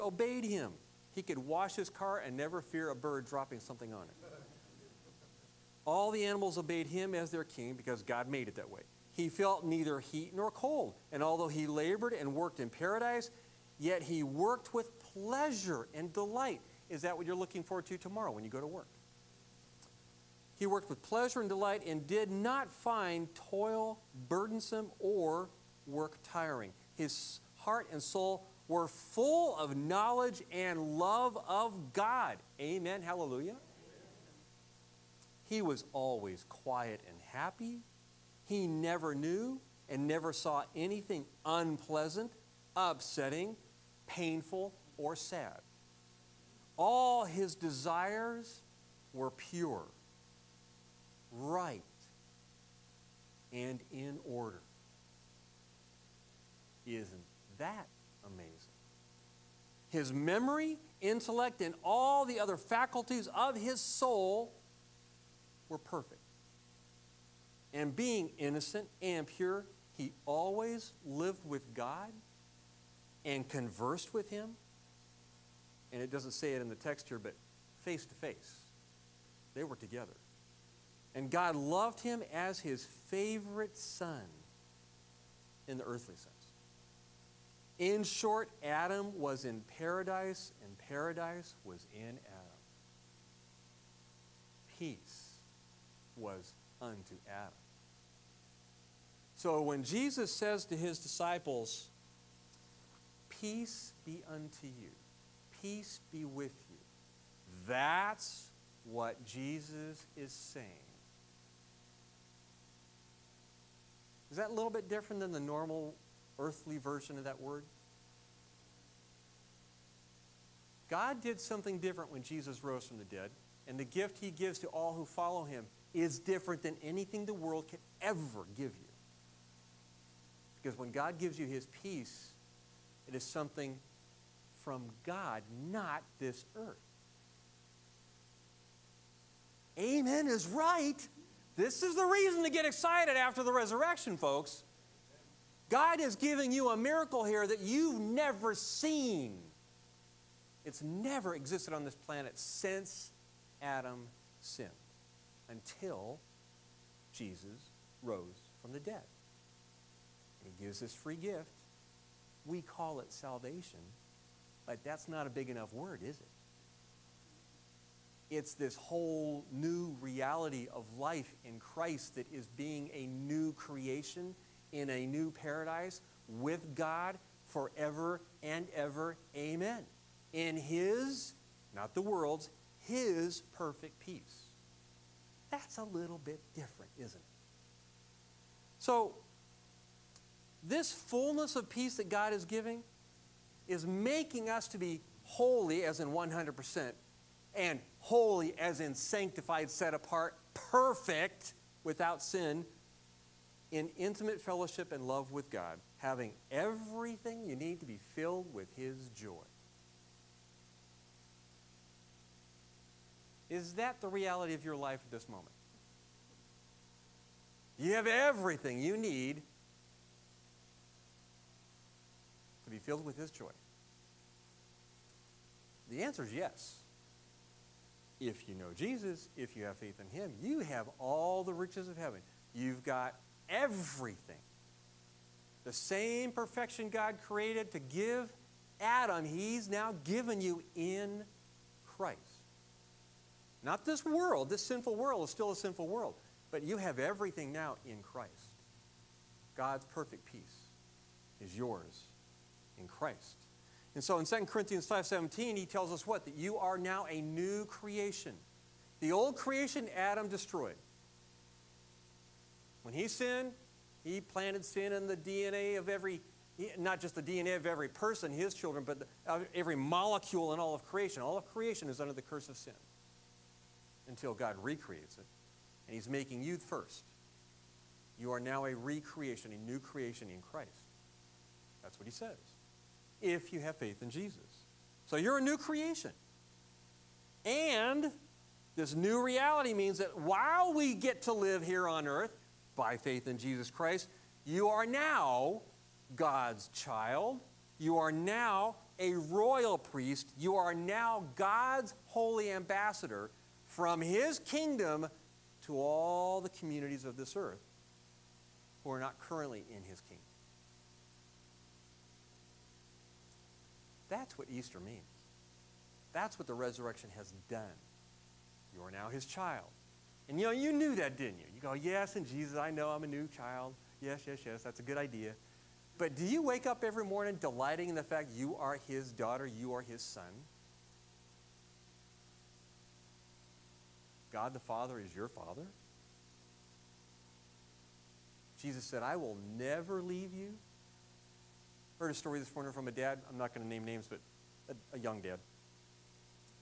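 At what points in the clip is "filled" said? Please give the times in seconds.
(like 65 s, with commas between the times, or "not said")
208 s, 222 s.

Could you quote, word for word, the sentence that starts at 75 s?
And it doesn't say it in the text here, but face to face.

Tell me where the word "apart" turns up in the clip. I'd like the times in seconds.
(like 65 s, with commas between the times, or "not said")
199 s.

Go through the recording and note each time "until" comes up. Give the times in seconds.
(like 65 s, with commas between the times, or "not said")
155 s, 274 s.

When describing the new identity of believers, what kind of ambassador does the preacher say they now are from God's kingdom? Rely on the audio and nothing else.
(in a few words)
holy ambassador.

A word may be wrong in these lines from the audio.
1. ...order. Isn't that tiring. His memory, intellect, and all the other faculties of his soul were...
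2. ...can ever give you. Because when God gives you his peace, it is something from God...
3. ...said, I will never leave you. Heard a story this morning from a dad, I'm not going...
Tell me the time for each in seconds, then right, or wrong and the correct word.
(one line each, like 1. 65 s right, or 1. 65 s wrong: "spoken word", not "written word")
1. 54 s wrong: "amazing", not "tiring"
2. 127 s right
3. 338 s right.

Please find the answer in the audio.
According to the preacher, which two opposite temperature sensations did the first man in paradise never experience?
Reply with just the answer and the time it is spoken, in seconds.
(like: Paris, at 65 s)
heat nor cold, at 9 s.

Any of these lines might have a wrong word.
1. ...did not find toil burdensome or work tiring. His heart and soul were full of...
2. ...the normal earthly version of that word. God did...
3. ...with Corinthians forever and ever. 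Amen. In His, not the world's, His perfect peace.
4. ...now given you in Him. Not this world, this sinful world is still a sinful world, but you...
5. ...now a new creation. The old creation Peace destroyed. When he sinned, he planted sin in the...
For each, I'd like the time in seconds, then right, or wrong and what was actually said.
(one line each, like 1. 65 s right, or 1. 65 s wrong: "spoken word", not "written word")
1. 22 s right
2. 115 s right
3. 176 s wrong: "God", not "Corinthians"
4. 239 s wrong: "Christ", not "Him"
5. 256 s wrong: "Adam", not "Peace".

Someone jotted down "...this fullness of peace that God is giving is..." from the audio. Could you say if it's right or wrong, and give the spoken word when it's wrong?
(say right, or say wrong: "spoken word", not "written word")
right.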